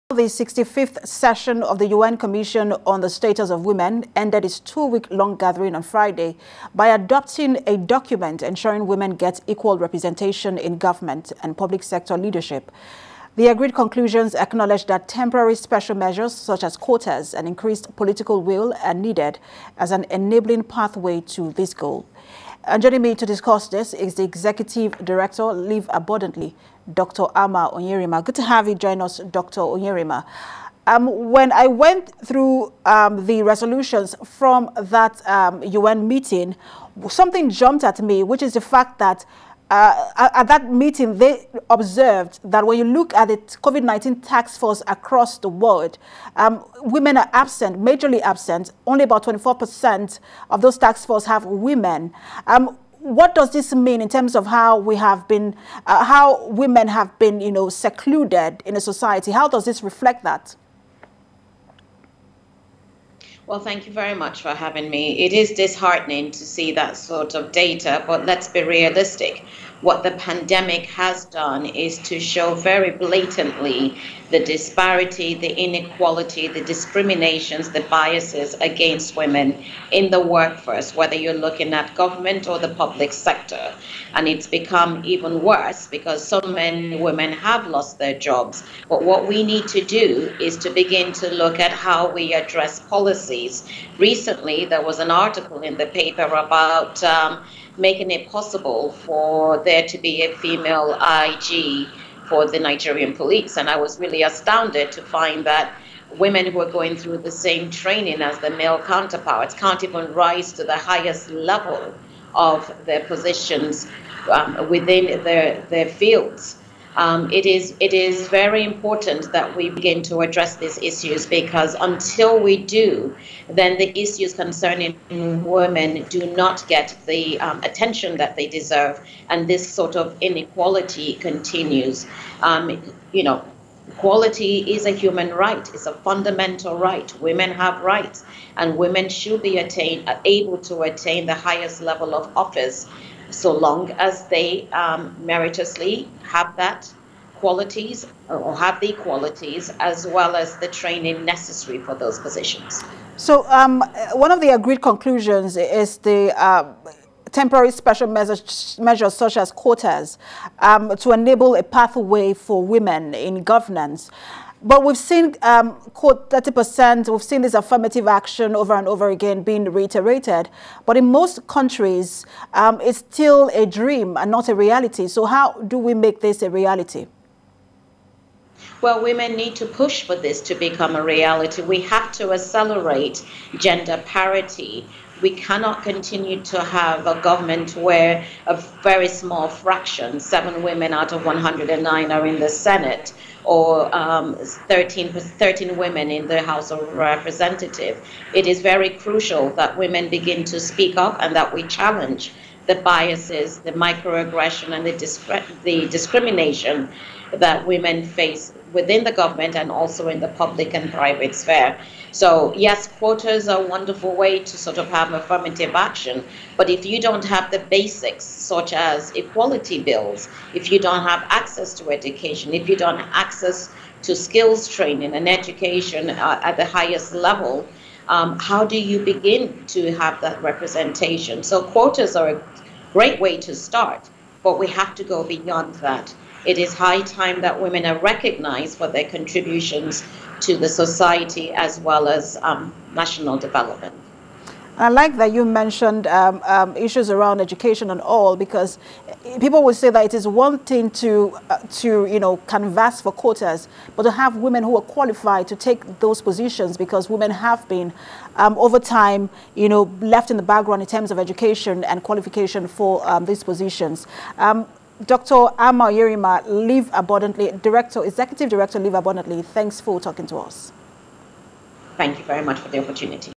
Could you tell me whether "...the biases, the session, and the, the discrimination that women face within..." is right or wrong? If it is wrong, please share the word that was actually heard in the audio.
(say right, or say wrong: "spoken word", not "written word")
wrong: "microaggression", not "session".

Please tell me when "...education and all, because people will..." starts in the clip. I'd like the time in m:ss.
4:07.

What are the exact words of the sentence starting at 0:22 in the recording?
And joining me to discuss this is the Executive Director, Live Abundantly, Dr.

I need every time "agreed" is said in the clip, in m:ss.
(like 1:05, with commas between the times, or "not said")
0:13, 2:34.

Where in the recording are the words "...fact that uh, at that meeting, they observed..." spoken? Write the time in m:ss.
0:38.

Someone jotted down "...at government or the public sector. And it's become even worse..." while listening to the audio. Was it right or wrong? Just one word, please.
right.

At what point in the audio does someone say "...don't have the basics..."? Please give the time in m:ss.
3:37.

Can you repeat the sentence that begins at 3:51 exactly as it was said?
So, quotas are a great way to start, but we have to go beyond that.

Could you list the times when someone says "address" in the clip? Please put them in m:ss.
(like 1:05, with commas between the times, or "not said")
1:32, 2:00.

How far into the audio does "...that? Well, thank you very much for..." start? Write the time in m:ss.
1:00.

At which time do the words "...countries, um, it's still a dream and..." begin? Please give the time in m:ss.
2:51.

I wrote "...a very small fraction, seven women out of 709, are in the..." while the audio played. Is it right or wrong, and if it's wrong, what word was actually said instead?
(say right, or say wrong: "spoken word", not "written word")
wrong: "109", not "709".